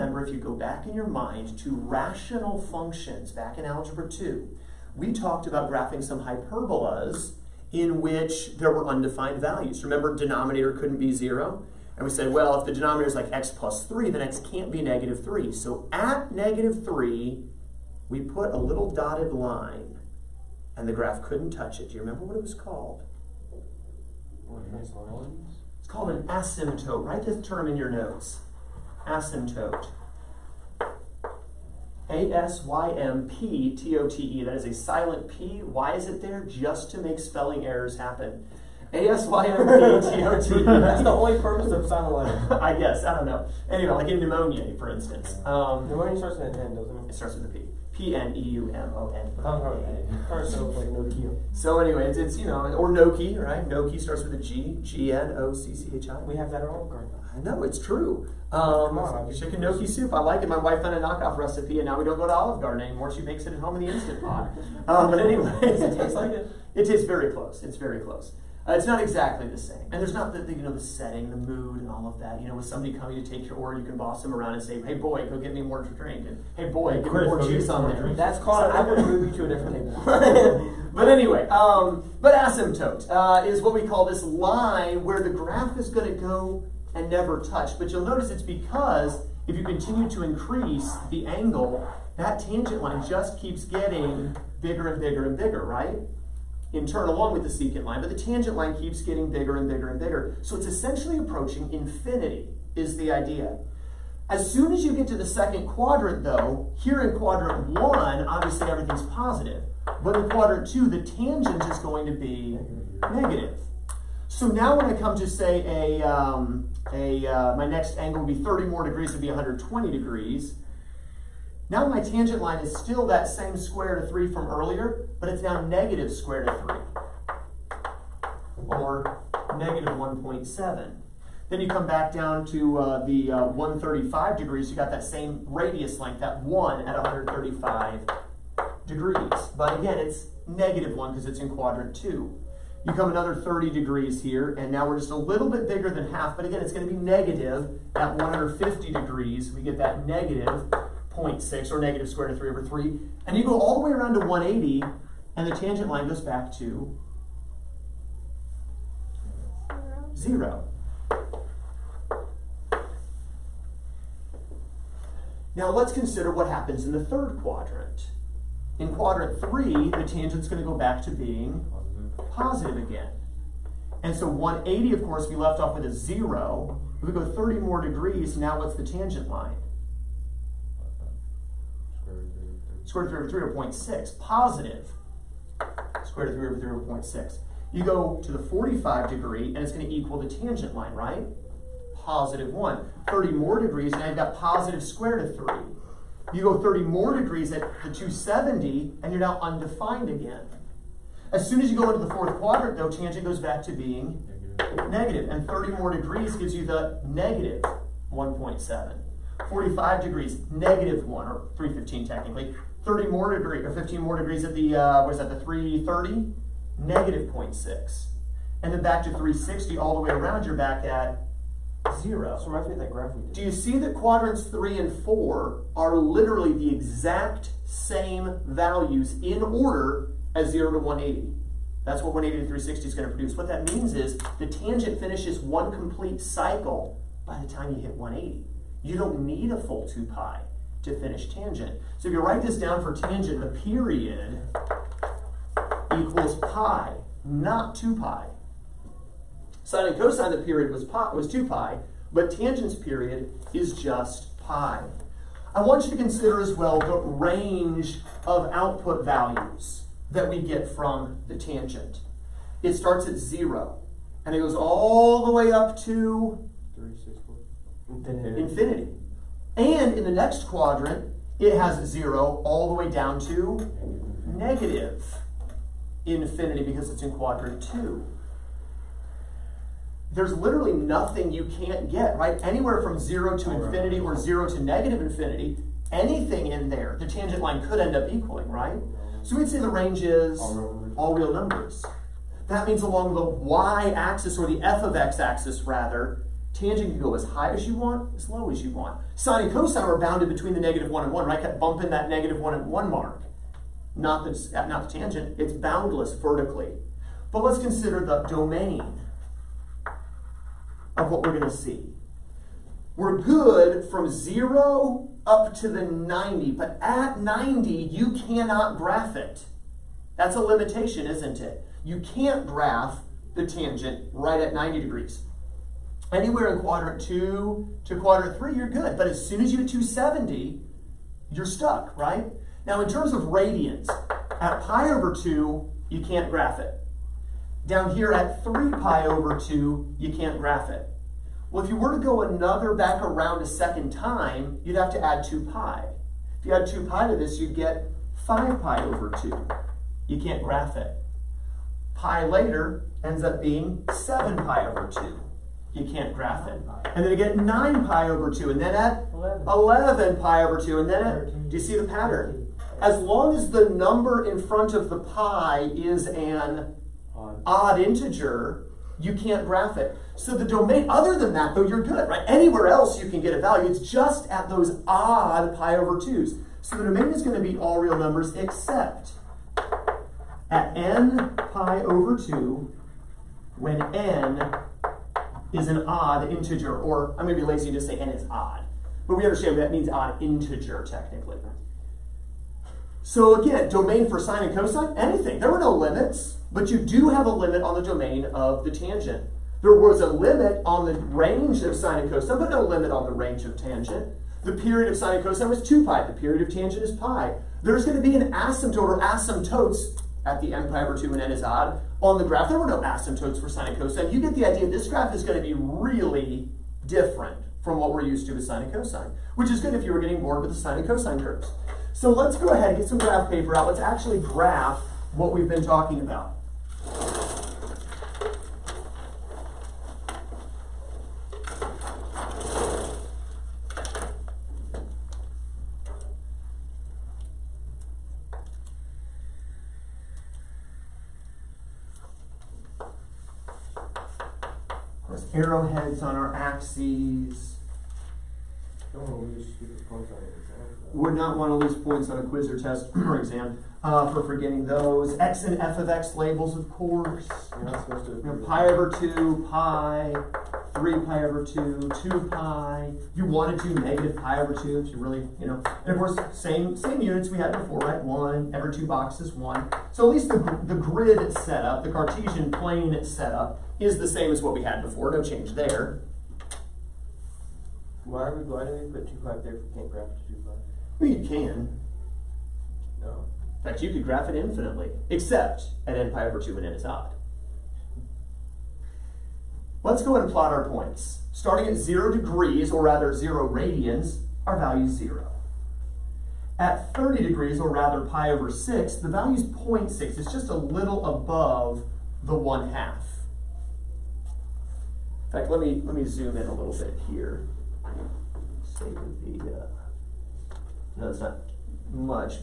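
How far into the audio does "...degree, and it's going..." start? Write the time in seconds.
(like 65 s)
189 s.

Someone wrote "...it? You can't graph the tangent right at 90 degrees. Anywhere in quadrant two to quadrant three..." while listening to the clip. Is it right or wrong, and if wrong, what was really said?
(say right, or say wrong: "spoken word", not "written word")
right.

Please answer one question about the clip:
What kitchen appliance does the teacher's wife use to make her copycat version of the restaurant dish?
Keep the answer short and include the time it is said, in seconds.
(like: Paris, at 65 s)
instant pot, at 63 s.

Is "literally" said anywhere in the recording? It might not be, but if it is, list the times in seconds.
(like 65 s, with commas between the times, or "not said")
225 s, 280 s.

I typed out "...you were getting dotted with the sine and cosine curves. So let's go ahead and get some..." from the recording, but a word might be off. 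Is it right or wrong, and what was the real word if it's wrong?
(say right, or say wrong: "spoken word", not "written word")
wrong: "bored", not "dotted".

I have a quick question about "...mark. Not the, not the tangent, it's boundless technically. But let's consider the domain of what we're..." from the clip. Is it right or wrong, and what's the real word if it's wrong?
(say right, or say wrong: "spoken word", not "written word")
wrong: "vertically", not "technically".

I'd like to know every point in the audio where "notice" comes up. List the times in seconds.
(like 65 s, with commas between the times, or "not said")
88 s.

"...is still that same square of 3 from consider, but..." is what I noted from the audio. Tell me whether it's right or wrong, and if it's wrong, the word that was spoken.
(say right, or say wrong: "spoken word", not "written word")
wrong: "earlier", not "consider".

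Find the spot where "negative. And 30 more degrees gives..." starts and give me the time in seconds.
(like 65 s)
204 s.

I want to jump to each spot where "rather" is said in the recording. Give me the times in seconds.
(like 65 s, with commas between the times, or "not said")
295 s, 492 s, 497 s.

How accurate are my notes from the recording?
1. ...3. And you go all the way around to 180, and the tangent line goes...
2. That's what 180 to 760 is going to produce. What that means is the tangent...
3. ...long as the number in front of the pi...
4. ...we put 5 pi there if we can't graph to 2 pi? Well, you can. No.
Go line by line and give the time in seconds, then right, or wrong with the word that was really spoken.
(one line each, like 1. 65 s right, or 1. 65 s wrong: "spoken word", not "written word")
1. 152 s right
2. 231 s wrong: "360", not "760"
3. 363 s right
4. 478 s wrong: "2", not "5".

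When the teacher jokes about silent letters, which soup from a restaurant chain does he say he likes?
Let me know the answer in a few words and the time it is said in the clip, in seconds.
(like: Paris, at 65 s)
chicken gnocchi soup, at 59 s.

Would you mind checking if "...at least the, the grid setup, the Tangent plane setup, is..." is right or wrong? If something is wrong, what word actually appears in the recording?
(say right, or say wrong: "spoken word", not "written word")
wrong: "Cartesian", not "Tangent".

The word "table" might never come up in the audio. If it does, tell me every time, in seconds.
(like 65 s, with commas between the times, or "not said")
79 s.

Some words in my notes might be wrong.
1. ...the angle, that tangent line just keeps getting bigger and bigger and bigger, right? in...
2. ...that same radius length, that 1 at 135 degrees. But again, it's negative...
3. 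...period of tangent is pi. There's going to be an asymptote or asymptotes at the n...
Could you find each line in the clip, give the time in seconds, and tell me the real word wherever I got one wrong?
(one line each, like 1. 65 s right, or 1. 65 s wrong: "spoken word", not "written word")
1. 91 s right
2. 134 s right
3. 406 s right.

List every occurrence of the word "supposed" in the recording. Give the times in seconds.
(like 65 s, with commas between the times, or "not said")
457 s.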